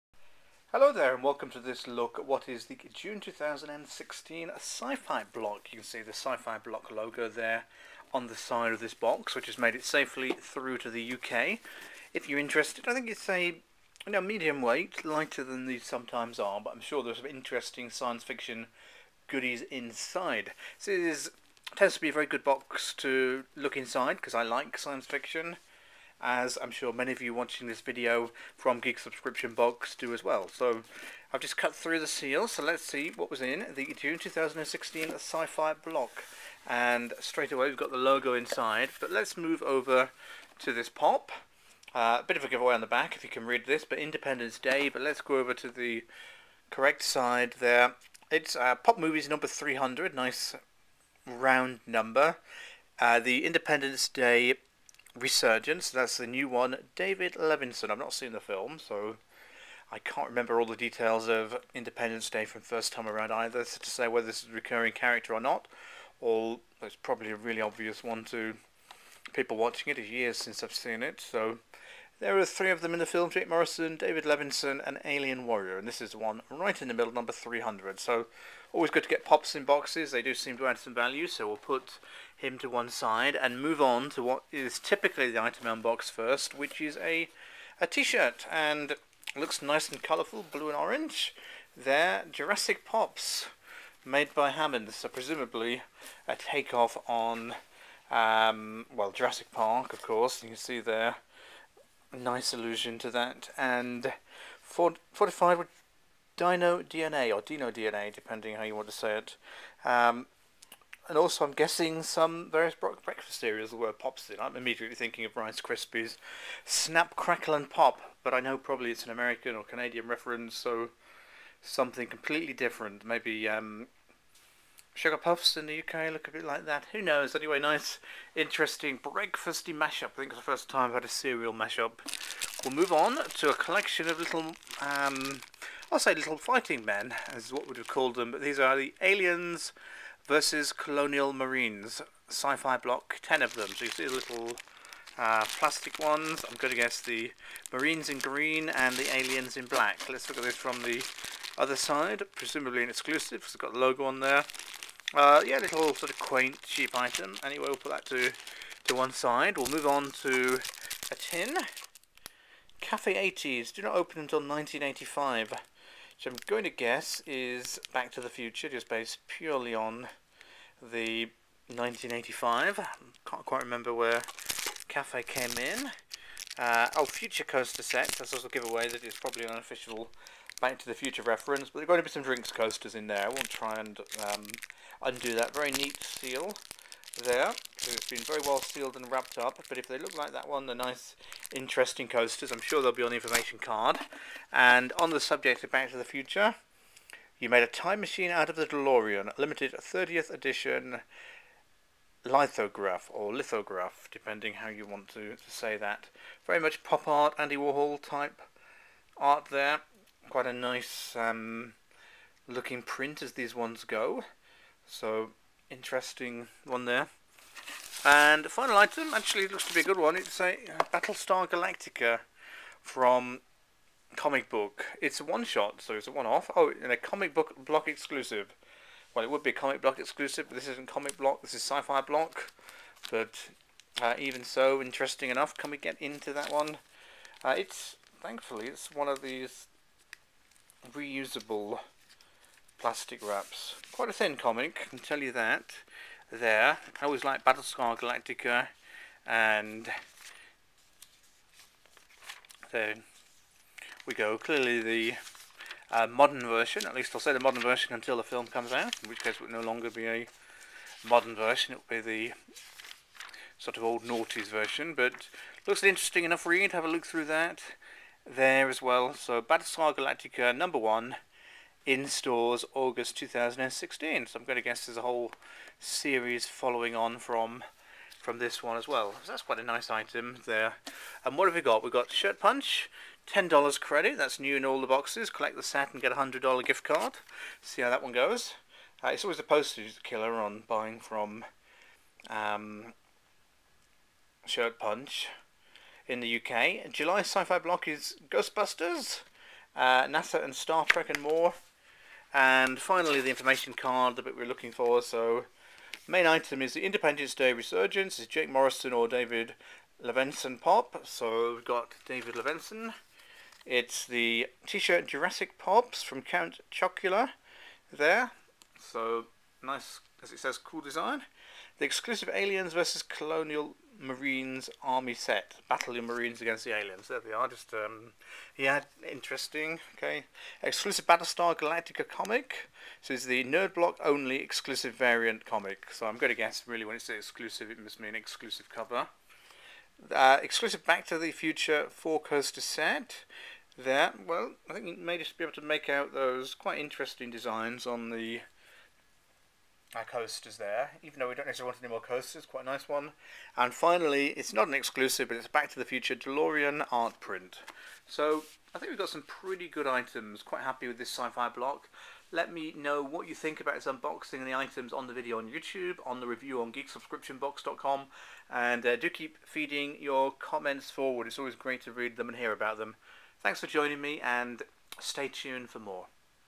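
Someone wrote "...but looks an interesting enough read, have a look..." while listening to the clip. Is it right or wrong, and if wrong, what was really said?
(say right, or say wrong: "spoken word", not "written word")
right.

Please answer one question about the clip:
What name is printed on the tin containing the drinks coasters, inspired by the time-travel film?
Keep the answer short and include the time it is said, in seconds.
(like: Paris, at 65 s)
Cafe 80s, at 162 s.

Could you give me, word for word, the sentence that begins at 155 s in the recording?
Uh, yeah, little sort of quaint, cheap item.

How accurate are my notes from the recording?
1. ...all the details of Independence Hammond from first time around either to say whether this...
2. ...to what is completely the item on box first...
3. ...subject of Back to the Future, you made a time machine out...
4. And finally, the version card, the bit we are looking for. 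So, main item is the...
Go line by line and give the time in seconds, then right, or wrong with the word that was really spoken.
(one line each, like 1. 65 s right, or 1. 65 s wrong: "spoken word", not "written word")
1. 60 s wrong: "Day", not "Hammond"
2. 84 s wrong: "typically", not "completely"
3. 195 s right
4. 302 s wrong: "information", not "version".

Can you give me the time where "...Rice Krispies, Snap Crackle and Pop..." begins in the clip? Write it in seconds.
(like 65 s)
115 s.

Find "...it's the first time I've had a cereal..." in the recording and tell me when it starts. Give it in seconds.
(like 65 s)
130 s.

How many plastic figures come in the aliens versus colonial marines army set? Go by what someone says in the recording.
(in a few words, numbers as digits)
10.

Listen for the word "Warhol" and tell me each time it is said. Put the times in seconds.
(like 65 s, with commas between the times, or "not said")
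207 s.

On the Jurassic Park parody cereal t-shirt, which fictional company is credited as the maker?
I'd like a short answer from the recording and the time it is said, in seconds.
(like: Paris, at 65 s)
Hammond, at 94 s.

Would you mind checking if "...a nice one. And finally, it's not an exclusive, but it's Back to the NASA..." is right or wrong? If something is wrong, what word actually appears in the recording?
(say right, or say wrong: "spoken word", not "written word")
wrong: "Future", not "NASA".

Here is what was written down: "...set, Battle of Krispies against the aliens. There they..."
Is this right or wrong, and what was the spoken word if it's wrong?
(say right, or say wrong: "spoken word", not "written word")
wrong: "Marines", not "Krispies".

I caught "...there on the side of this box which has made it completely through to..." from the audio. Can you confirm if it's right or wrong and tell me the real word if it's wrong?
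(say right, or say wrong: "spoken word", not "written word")
wrong: "safely", not "completely".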